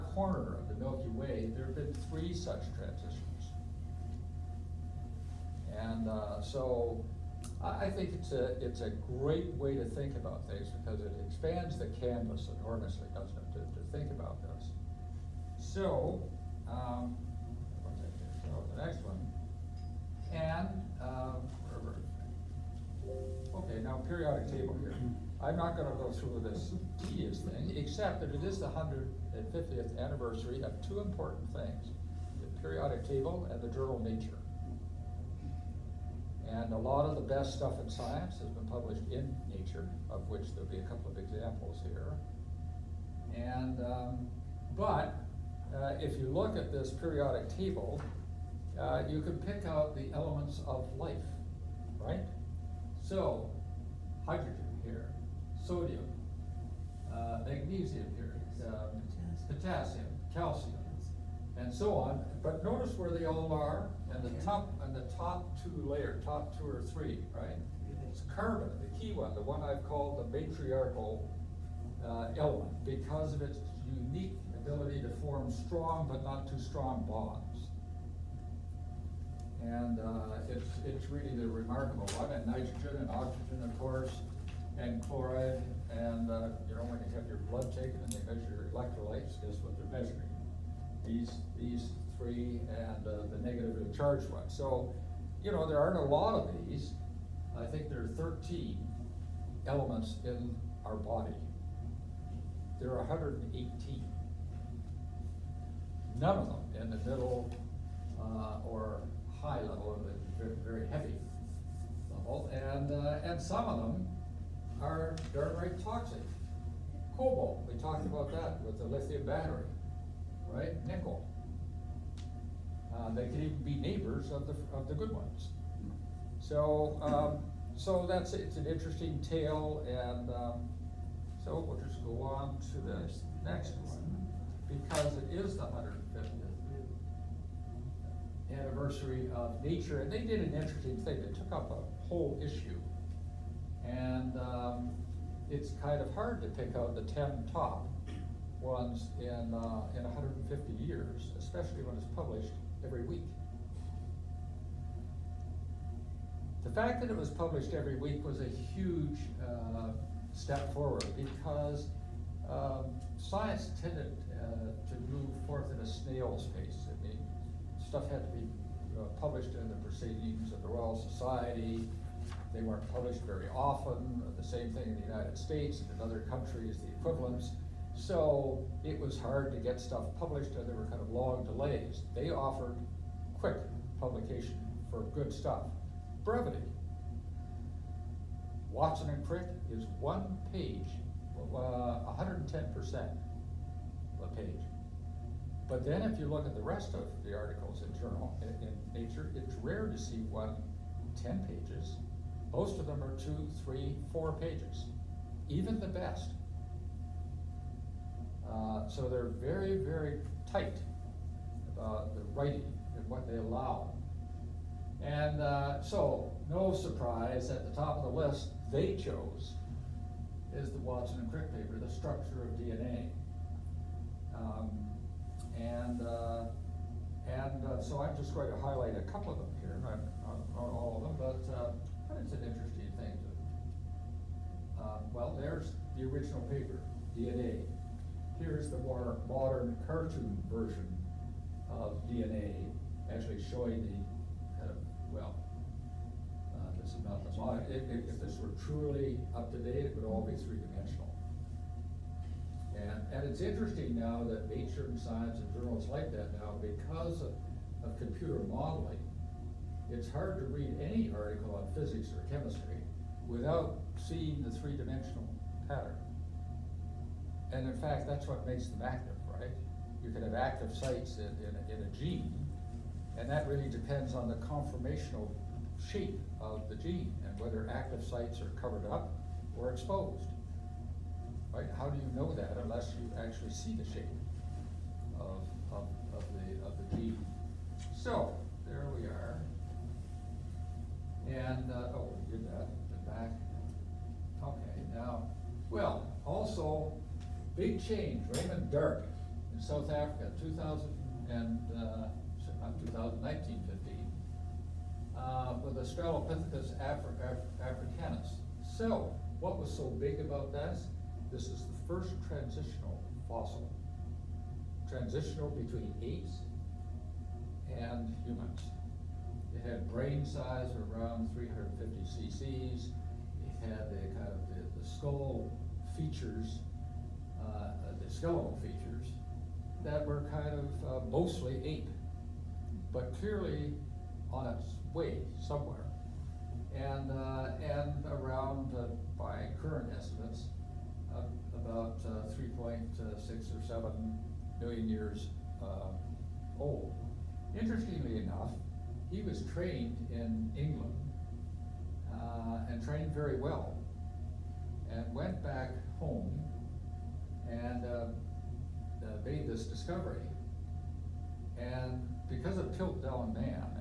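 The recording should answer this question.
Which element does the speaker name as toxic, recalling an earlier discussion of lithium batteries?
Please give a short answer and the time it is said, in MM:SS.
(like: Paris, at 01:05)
Cobalt, at 01:57.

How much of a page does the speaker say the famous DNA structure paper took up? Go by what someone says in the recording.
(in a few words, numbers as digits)
110%.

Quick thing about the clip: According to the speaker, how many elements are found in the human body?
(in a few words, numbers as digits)
13.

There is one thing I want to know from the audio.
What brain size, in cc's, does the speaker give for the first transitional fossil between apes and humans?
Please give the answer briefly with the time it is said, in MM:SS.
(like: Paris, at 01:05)
350, at 05:21.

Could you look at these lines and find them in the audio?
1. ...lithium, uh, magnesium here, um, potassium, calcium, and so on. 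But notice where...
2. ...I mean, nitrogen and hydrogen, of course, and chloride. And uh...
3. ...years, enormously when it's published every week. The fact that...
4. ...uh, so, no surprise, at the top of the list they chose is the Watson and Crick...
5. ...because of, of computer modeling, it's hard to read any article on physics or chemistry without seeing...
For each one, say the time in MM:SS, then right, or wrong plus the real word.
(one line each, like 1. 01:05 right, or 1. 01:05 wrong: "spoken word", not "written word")
1. 00:55 wrong: "sodium", not "lithium"
2. 01:22 wrong: "oxygen", not "hydrogen"
3. 02:30 wrong: "especially", not "enormously"
4. 03:35 right
5. 04:16 right.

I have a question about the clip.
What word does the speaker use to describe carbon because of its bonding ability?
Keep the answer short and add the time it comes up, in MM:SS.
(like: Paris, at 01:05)
matriarchal, at 01:10.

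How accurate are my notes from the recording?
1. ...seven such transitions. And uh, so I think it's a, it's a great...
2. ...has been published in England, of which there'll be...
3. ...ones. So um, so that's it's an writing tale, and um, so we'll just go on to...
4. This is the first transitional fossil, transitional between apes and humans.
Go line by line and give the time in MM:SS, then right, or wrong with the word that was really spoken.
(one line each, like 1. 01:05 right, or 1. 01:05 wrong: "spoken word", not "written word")
1. 00:02 wrong: "three", not "seven"
2. 00:38 wrong: "Nature", not "England"
3. 02:05 wrong: "interesting", not "writing"
4. 05:11 right.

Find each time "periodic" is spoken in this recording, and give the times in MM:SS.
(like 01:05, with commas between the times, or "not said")
00:24, 00:32, 00:46.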